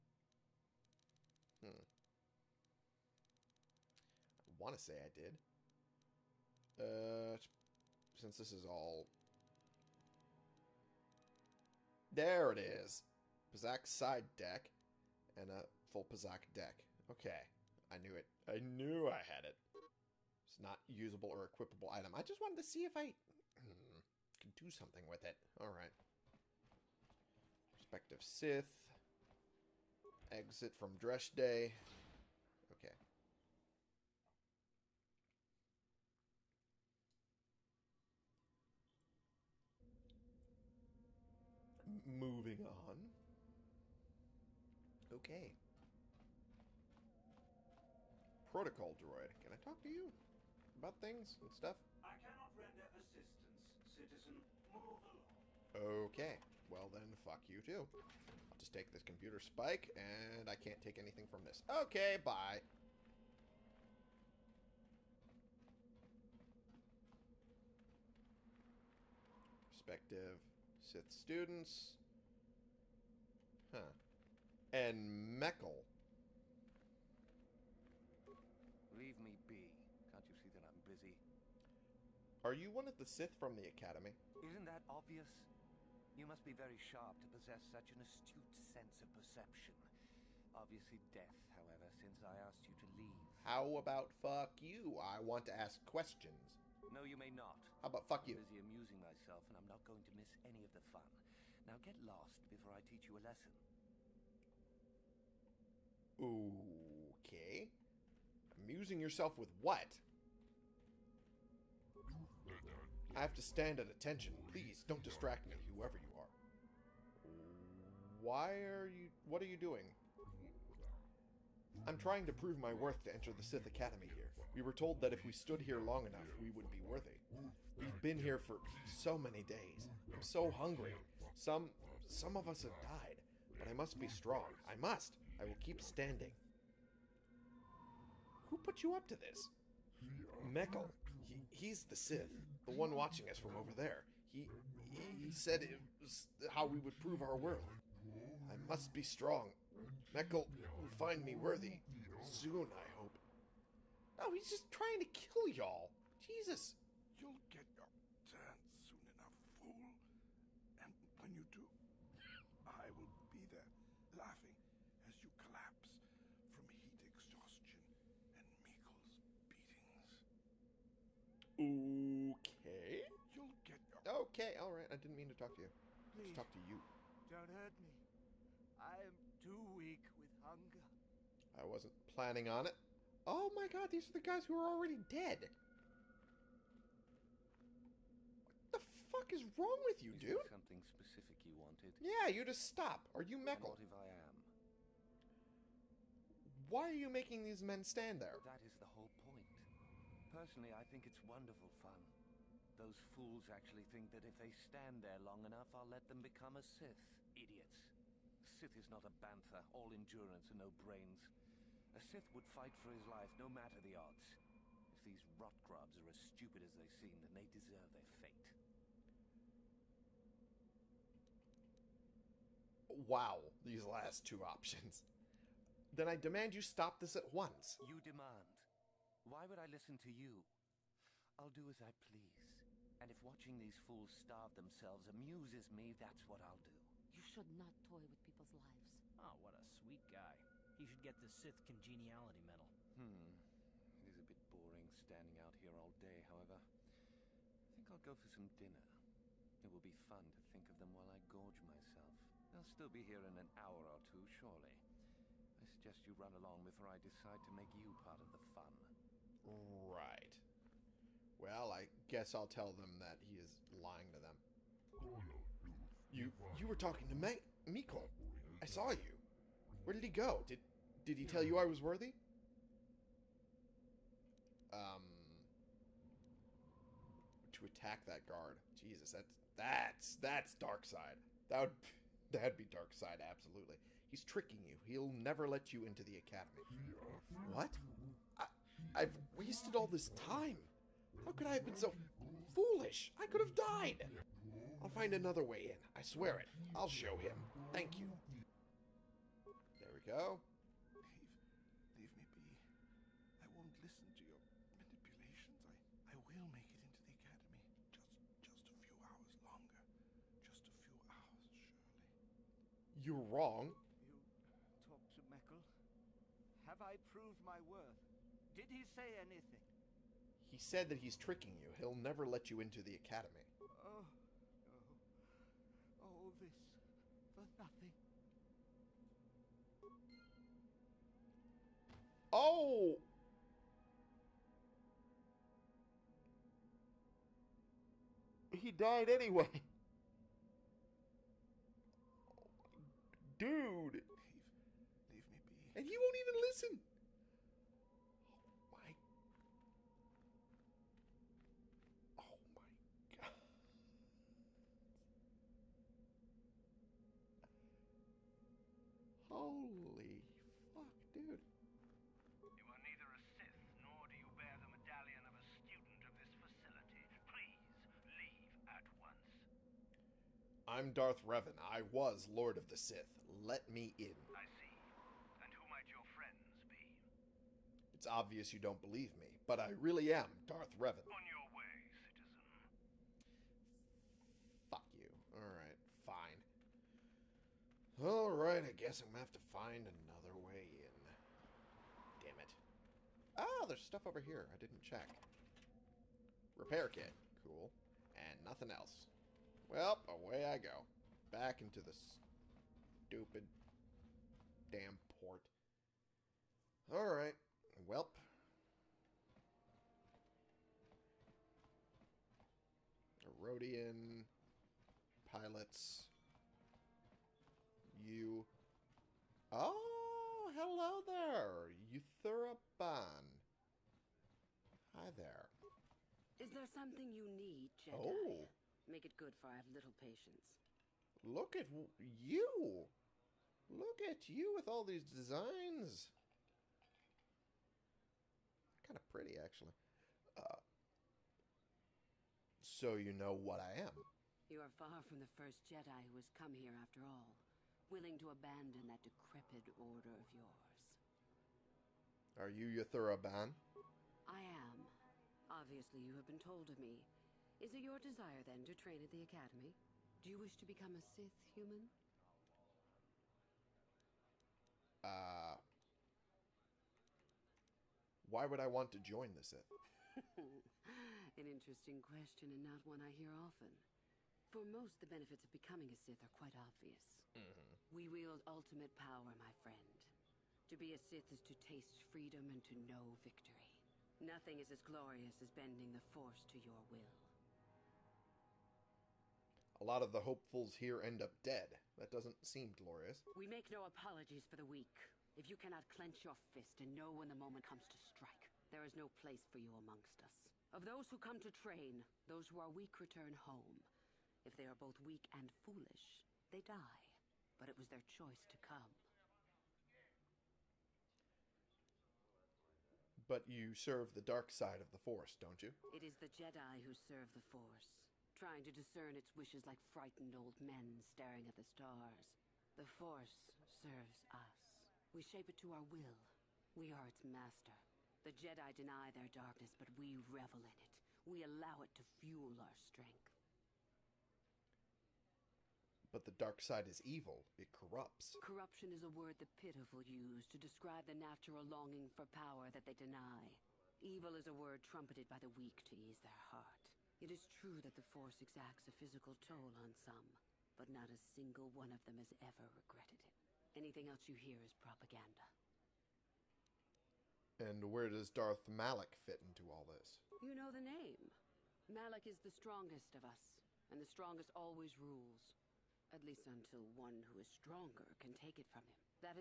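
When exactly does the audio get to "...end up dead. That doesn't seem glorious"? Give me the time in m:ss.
8:11.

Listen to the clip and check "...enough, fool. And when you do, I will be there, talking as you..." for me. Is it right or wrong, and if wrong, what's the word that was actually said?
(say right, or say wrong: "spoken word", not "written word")
wrong: "laughing", not "talking".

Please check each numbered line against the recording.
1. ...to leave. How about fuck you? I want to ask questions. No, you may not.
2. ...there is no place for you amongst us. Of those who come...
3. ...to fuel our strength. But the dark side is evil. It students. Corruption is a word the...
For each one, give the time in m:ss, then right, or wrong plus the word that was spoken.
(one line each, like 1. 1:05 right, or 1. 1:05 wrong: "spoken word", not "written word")
1. 1:32 right
2. 8:18 right
3. 8:51 wrong: "corrupts", not "students".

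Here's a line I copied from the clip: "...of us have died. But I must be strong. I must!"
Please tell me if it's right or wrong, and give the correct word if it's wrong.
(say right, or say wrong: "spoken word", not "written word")
right.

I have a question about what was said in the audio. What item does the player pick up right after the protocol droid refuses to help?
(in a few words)
Computer spike.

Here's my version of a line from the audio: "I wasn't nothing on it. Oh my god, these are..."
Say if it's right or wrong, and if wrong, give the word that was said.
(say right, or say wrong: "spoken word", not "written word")
wrong: "planning", not "nothing".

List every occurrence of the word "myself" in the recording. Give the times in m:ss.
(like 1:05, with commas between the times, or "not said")
1:38, 4:11.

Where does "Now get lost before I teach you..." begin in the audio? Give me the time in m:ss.
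1:41.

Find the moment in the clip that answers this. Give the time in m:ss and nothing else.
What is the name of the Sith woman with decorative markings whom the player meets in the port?
7:01.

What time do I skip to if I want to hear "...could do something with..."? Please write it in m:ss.
0:24.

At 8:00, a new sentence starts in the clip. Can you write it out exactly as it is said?
To be a Sith is to taste freedom and to know victory.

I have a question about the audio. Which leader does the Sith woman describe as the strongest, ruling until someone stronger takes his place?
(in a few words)
Darth Malak.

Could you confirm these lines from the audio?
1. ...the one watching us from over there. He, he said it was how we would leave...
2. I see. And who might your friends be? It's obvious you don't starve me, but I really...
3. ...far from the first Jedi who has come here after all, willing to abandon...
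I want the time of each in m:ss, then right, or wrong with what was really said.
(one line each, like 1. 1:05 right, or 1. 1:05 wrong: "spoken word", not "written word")
1. 2:22 wrong: "prove", not "leave"
2. 6:14 wrong: "believe", not "starve"
3. 7:24 right.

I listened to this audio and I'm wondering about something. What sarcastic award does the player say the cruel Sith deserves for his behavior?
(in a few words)
Sith Congeniality Medal.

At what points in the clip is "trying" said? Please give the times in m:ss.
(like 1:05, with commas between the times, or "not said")
2:01, 2:34, 8:38.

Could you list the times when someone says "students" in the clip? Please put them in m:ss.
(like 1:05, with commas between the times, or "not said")
1:11, 6:05.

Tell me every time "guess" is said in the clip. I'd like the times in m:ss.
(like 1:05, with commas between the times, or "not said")
4:22, 6:28.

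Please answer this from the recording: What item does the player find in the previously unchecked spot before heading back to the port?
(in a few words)
Repair kit.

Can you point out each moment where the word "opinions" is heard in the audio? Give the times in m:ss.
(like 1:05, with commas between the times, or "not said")
not said.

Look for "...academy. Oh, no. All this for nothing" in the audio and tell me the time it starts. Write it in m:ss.
5:22.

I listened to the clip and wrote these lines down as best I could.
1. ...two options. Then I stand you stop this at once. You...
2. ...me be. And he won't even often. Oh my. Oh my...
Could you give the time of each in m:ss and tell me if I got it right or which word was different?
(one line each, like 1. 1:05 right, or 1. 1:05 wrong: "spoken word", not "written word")
1. 3:44 wrong: "demand", not "stand"
2. 5:45 wrong: "listen", not "often".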